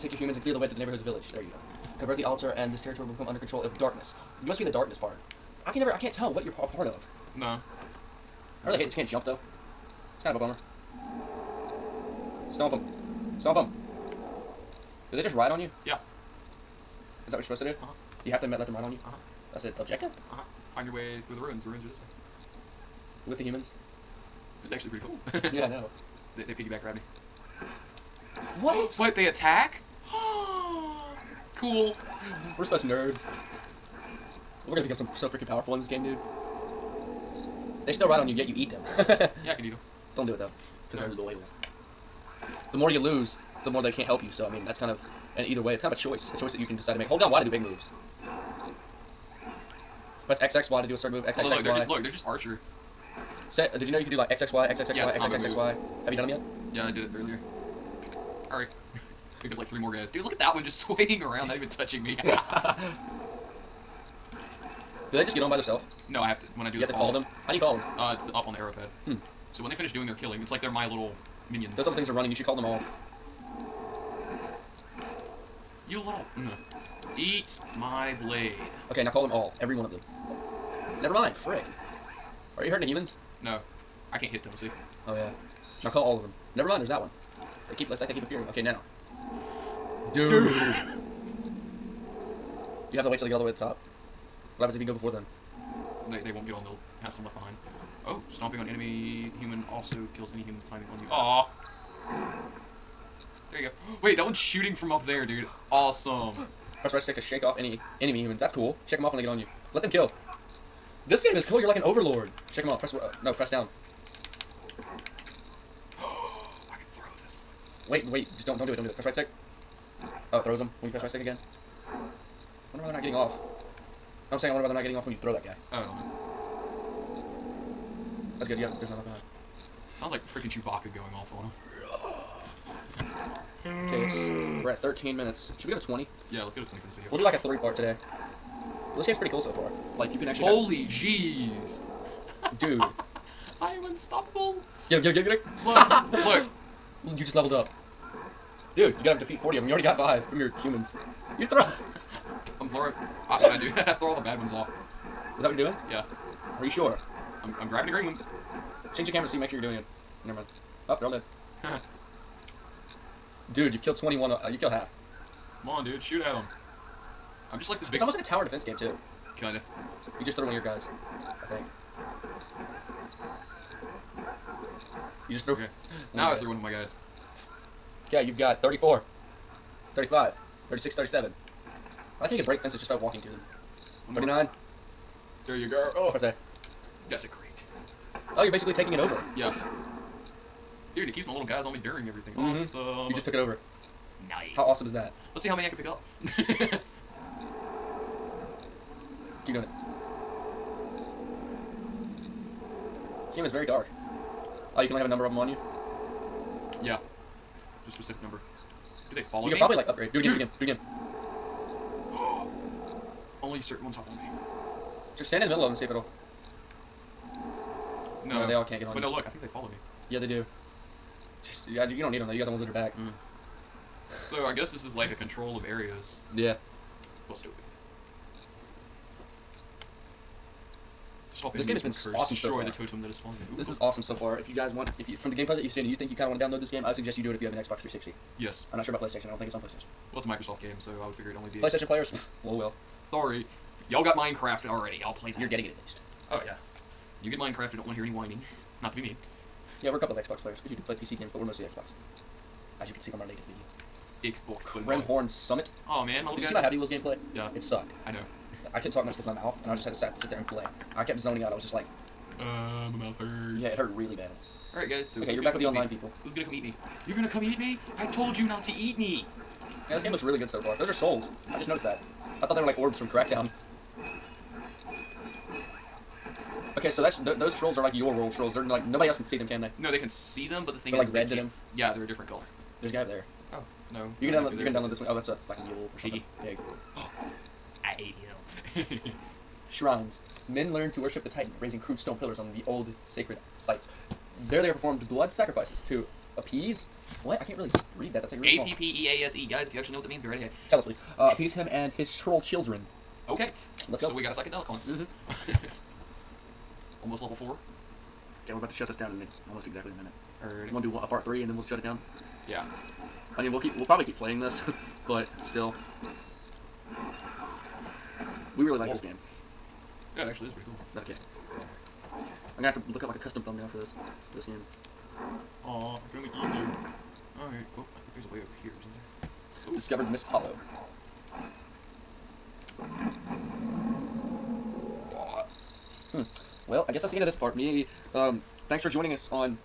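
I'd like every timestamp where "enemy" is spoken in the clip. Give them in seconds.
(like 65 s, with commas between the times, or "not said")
98 s, 108 s.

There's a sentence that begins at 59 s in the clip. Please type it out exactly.
Picked up like three more guys.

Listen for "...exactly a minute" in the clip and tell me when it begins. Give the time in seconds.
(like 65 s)
309 s.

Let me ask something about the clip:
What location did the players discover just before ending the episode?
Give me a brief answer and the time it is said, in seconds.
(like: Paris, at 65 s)
Mist Hollow, at 330 s.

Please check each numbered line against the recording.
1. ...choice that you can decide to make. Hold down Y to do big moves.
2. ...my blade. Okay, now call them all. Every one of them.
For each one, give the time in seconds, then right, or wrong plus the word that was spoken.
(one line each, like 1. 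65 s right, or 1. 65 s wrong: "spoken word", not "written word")
1. 46 s right
2. 77 s right.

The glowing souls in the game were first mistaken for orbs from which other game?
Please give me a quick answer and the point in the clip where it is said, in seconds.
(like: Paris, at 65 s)
Crackdown, at 273 s.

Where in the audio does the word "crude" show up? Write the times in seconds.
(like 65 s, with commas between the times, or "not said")
291 s.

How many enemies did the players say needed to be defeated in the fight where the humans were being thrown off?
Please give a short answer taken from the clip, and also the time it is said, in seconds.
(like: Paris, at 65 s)
40, at 149 s.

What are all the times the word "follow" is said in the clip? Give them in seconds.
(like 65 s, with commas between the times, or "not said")
209 s, 219 s.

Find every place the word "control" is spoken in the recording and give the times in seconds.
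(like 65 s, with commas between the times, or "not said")
3 s, 225 s.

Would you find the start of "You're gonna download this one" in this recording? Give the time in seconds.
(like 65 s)
284 s.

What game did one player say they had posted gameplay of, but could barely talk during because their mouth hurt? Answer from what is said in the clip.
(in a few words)
Happy Wheels.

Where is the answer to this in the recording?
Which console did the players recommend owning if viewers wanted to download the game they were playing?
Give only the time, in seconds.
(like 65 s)
237 s.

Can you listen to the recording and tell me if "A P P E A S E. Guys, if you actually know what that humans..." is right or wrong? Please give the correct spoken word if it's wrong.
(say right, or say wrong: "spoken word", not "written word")
wrong: "means", not "humans".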